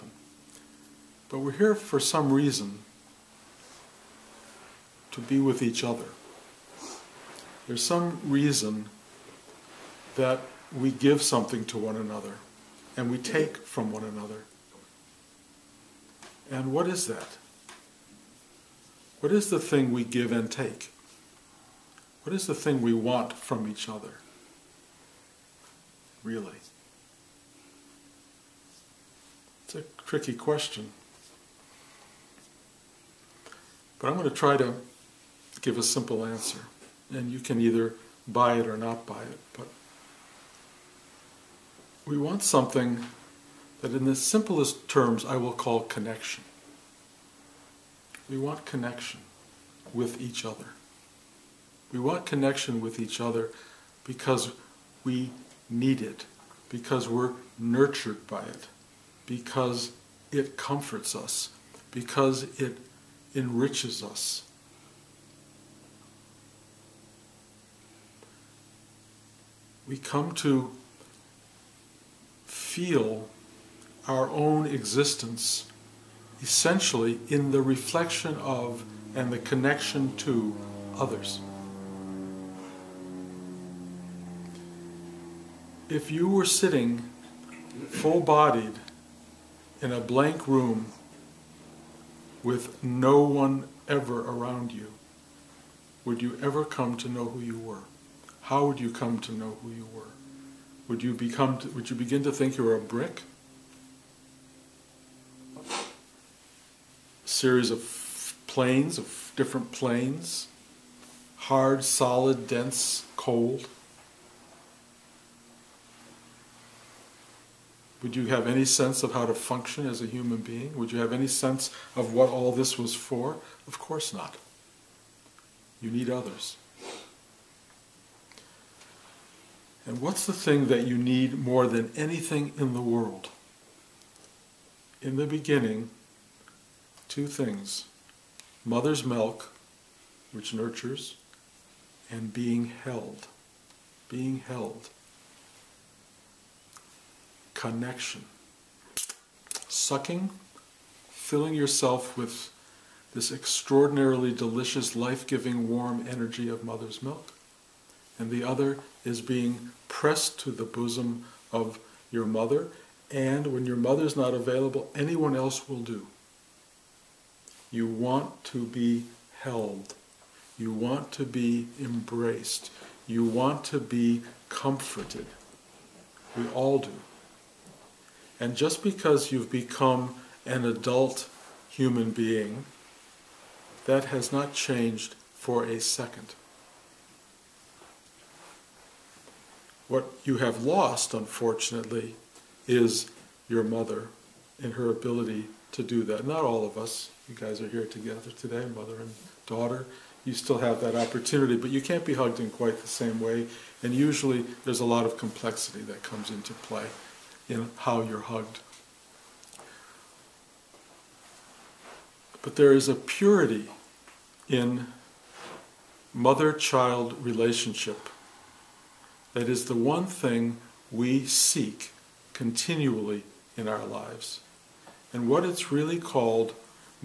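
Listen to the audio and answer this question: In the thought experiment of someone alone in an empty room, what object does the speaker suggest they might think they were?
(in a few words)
A brick.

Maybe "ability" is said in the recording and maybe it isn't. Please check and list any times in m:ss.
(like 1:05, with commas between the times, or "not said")
3:14.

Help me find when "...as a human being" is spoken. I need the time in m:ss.
1:59.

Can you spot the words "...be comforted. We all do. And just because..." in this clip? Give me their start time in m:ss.
2:53.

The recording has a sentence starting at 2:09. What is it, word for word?
And what's the thing that you need more than anything in the world?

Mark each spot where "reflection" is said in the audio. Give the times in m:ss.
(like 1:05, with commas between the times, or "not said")
1:17.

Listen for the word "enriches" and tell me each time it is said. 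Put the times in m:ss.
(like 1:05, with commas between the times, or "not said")
1:03.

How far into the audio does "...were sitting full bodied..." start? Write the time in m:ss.
1:26.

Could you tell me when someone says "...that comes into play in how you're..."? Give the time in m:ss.
3:25.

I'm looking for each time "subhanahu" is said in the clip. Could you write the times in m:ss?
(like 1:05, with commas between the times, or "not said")
not said.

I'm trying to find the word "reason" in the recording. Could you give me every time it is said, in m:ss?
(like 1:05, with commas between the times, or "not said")
0:02, 0:08.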